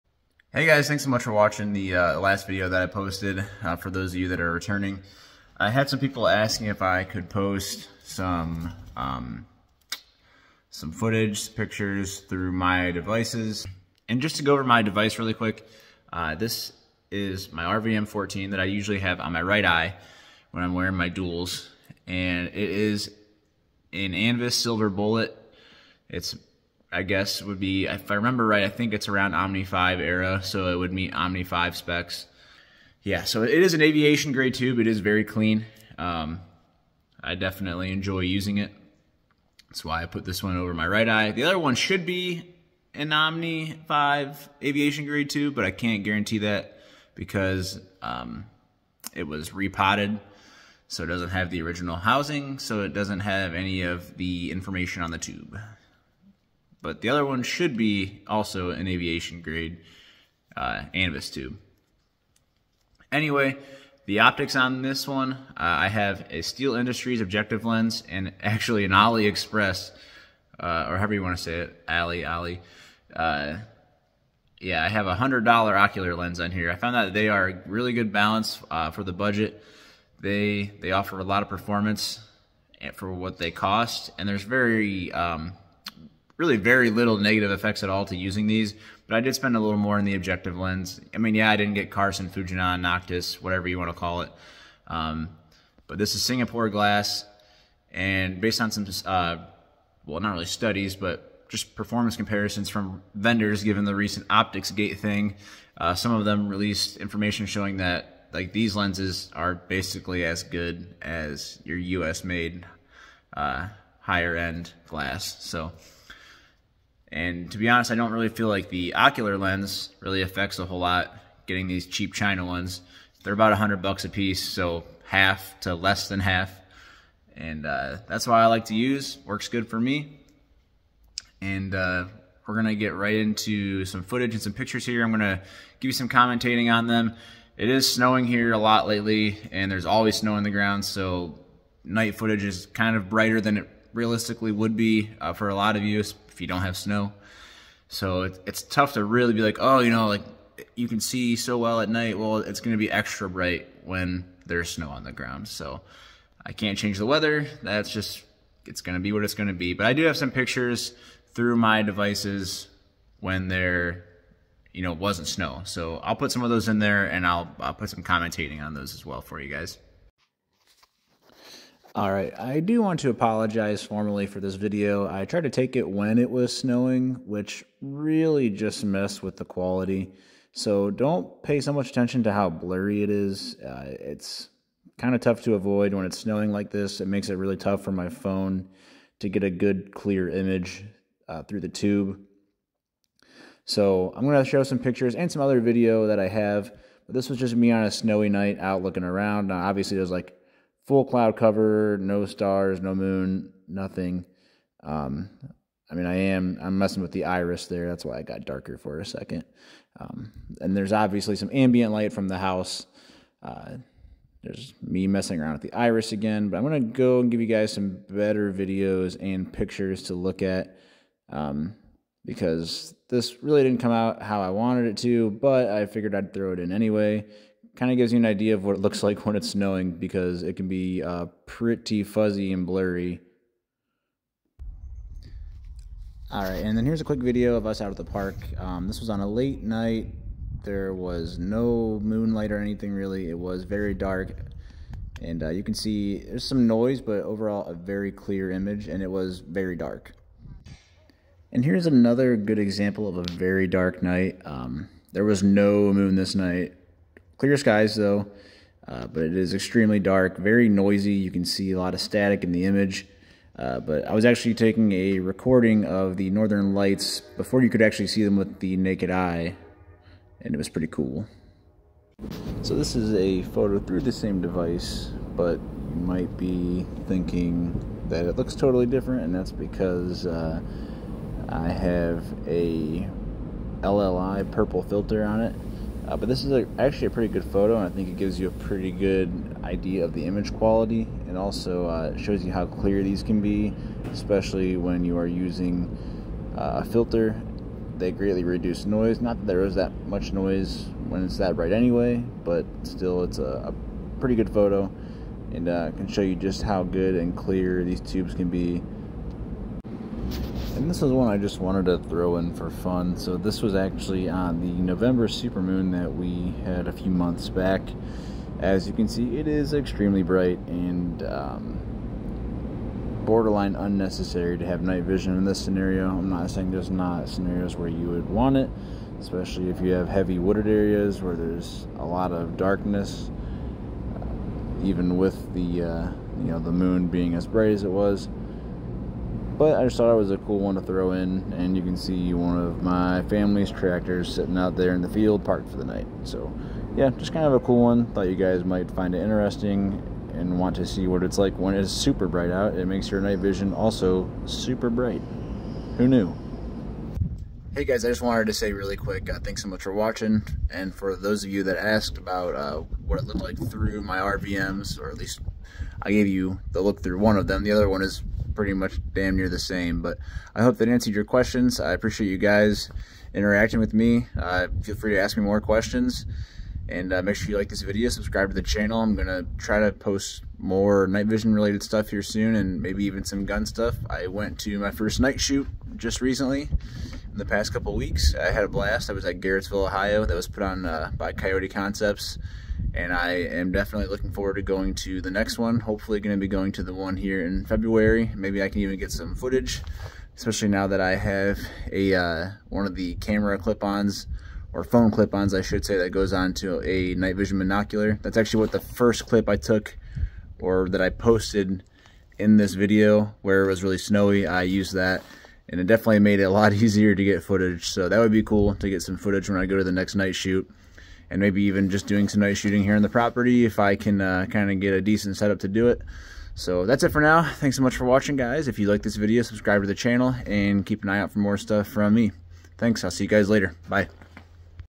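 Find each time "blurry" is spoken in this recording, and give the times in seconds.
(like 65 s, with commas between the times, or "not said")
182 s, 232 s.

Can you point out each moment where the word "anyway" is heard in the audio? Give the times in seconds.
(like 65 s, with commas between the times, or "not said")
63 s, 226 s, 301 s.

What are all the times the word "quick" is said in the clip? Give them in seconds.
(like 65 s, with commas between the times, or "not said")
15 s, 237 s, 358 s.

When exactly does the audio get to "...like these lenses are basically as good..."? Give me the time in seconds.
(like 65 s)
108 s.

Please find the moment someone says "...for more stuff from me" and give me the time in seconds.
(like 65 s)
431 s.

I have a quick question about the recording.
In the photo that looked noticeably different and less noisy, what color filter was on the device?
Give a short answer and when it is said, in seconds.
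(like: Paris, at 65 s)
Purple, at 284 s.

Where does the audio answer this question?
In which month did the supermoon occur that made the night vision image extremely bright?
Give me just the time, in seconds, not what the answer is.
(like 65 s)
314 s.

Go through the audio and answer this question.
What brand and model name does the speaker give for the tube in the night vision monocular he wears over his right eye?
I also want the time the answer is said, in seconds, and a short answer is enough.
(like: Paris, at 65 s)
Anvis Silver Bullet, at 24 s.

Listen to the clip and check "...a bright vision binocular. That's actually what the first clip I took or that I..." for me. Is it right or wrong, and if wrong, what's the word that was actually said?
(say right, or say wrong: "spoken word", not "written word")
wrong: "night", not "bright".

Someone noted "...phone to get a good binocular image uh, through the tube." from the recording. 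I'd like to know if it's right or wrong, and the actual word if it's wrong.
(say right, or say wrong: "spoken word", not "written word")
wrong: "clear", not "binocular".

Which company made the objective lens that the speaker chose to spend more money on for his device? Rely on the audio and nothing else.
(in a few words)
Steele Industries.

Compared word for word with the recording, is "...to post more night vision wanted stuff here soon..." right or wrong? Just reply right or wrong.
wrong.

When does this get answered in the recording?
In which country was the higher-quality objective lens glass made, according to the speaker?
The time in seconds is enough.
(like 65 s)
96 s.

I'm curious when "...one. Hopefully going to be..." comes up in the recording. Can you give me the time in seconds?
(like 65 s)
395 s.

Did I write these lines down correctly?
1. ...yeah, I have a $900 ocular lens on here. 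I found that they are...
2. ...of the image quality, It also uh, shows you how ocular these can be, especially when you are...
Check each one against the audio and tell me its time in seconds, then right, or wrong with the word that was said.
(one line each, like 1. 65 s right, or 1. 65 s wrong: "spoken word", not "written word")
1. 74 s wrong: "100", not "900"
2. 290 s wrong: "clear", not "ocular".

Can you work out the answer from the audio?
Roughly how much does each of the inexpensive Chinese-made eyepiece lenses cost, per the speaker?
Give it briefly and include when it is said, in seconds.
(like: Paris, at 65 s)
$100, at 123 s.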